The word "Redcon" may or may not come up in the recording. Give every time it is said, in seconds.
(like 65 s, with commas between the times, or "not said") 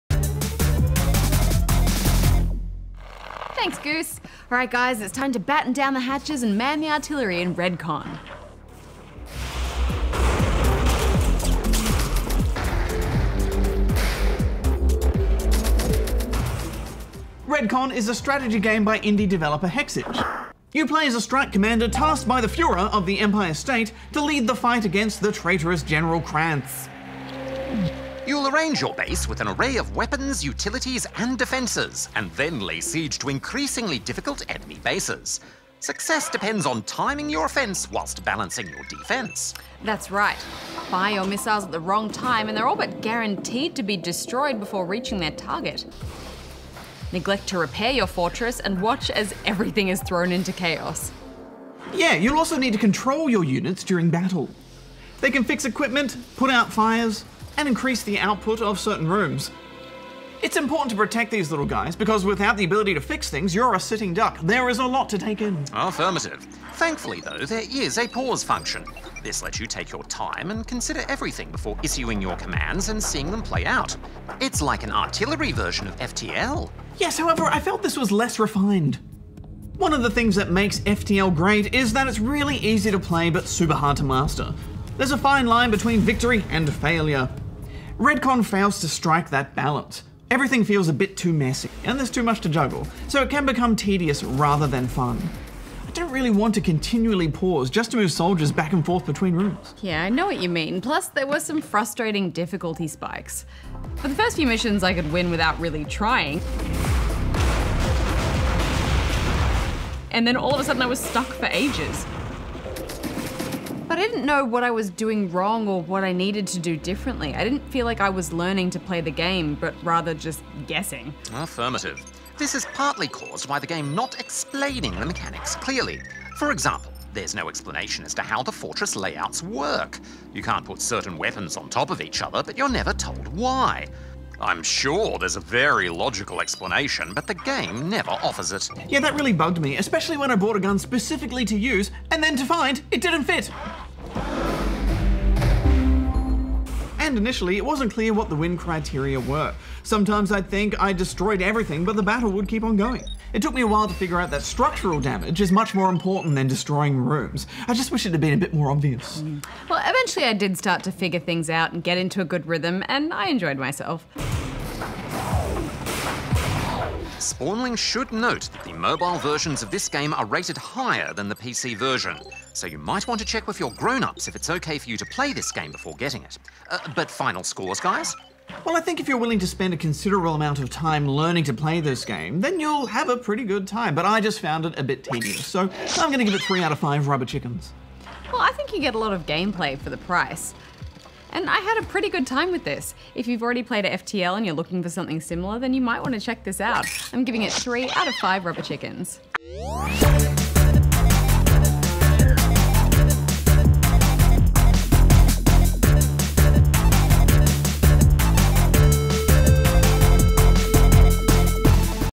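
7 s, 17 s, 87 s.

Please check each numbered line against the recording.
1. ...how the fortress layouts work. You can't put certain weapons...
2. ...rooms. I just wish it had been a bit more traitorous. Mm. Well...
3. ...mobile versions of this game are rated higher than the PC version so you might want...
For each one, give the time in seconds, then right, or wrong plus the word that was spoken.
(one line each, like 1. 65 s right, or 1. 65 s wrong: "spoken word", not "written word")
1. 128 s right
2. 156 s wrong: "obvious", not "traitorous"
3. 168 s right.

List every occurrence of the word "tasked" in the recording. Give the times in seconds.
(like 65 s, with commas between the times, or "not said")
21 s.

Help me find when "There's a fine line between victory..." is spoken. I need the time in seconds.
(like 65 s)
85 s.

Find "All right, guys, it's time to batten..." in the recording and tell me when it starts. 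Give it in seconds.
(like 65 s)
4 s.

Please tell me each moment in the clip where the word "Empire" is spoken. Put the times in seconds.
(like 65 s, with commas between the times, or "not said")
23 s.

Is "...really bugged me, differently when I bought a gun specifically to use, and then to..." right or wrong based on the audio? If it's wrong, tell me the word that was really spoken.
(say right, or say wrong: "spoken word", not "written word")
wrong: "especially", not "differently".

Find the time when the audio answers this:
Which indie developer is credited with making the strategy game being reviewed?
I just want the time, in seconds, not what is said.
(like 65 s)
19 s.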